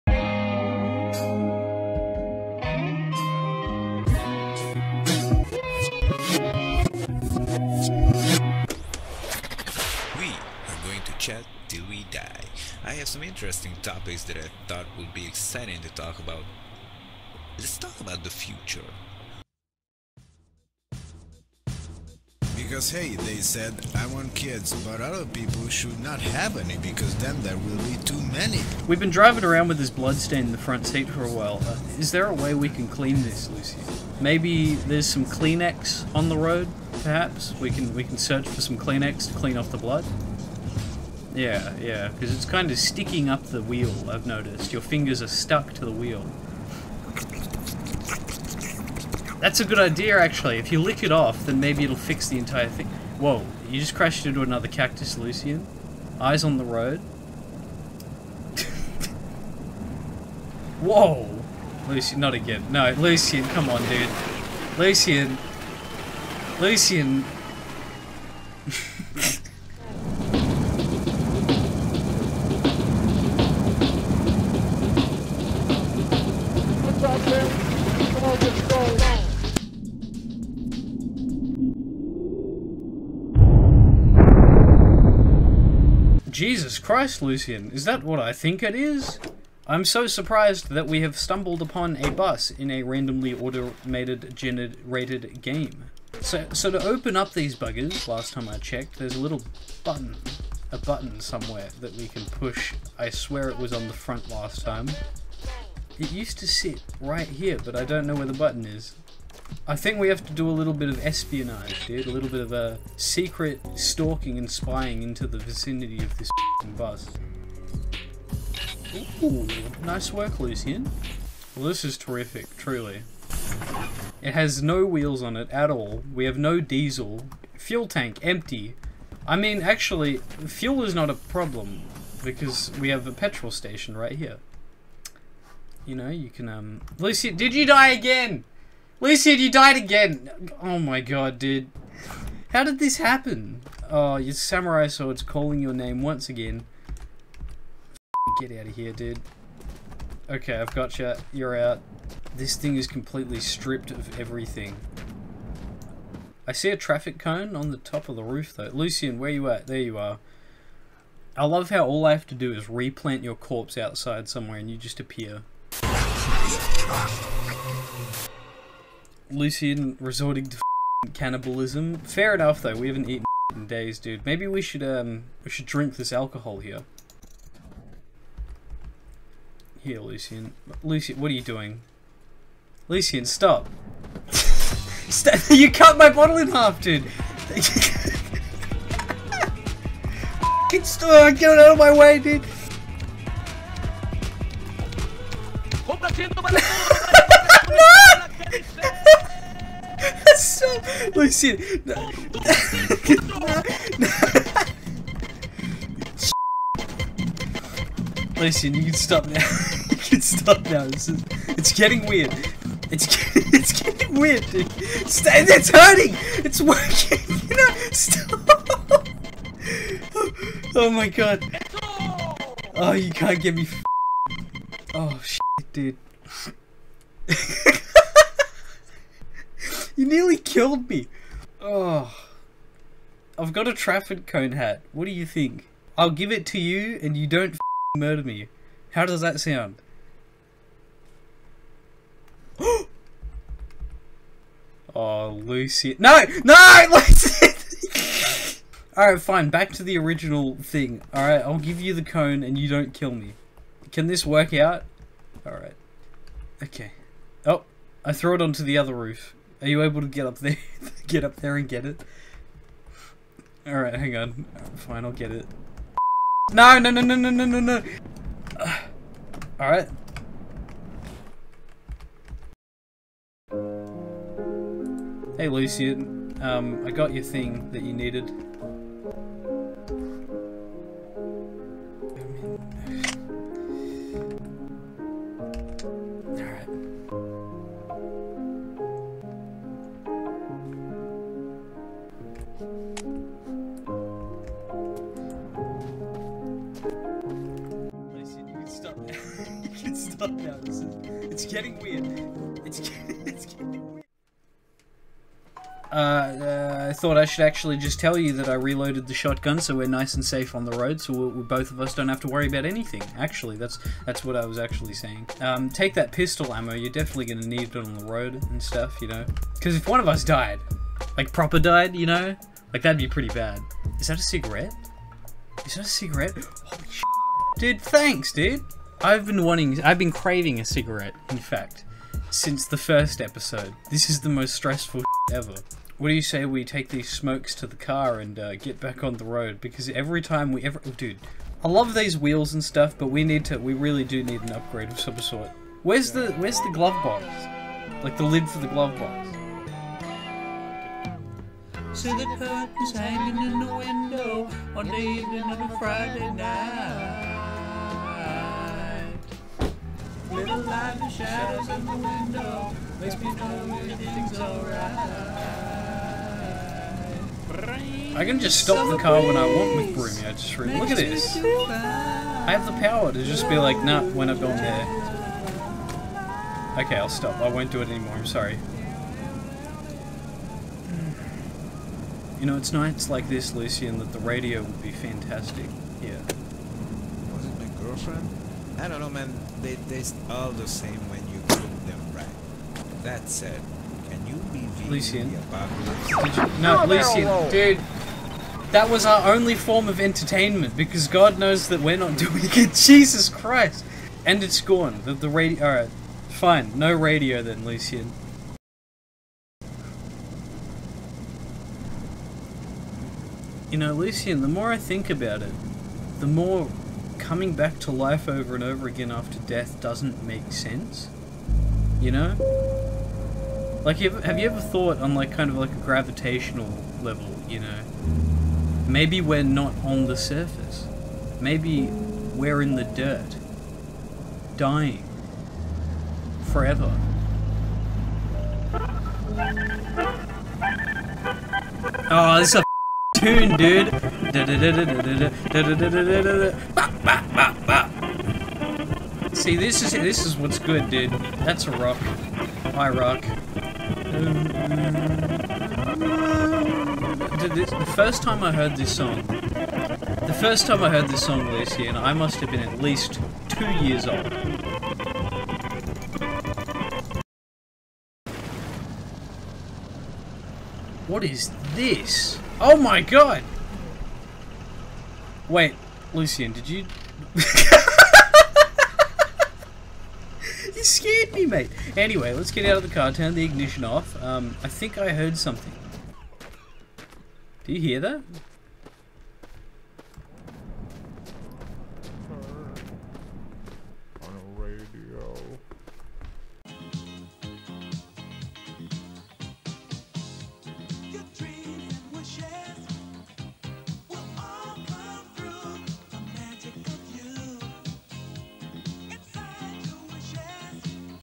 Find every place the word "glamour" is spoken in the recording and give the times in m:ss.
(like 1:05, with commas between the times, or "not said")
not said.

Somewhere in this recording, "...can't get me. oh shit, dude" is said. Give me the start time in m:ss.
3:43.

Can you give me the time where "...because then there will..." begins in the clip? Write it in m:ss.
0:26.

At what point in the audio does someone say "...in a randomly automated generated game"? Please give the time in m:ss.
1:32.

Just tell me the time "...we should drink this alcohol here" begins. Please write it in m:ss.
2:55.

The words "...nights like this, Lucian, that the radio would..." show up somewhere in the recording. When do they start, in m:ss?
6:22.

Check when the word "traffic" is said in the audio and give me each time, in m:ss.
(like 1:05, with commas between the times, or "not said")
2:36, 3:53.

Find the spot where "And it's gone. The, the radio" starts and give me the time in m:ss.
6:44.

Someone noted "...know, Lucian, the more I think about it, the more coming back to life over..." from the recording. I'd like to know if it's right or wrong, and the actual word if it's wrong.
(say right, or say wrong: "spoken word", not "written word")
right.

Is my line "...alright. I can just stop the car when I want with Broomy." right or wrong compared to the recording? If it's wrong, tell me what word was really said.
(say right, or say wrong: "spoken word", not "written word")
right.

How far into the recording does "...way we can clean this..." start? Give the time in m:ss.
0:32.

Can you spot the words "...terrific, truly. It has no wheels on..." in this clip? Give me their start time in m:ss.
2:01.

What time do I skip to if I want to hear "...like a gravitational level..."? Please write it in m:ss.
7:05.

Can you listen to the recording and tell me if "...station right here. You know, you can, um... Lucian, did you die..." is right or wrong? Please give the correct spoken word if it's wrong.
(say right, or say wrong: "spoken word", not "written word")
right.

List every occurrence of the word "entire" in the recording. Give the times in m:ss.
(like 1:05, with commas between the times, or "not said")
0:52.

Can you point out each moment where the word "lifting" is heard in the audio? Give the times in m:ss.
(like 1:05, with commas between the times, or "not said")
not said.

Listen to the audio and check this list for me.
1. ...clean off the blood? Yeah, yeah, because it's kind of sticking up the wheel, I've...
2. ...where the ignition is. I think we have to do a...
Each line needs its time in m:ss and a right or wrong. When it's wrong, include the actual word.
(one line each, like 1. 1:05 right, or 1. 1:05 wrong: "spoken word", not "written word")
1. 0:39 right
2. 1:48 wrong: "button", not "ignition".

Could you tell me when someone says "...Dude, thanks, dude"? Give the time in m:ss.
5:27.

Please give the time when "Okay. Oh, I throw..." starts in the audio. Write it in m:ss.
4:16.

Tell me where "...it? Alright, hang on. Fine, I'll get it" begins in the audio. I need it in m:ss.
4:21.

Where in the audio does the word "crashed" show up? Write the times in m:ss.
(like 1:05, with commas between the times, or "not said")
0:53.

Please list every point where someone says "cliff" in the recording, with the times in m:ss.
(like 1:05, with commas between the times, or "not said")
not said.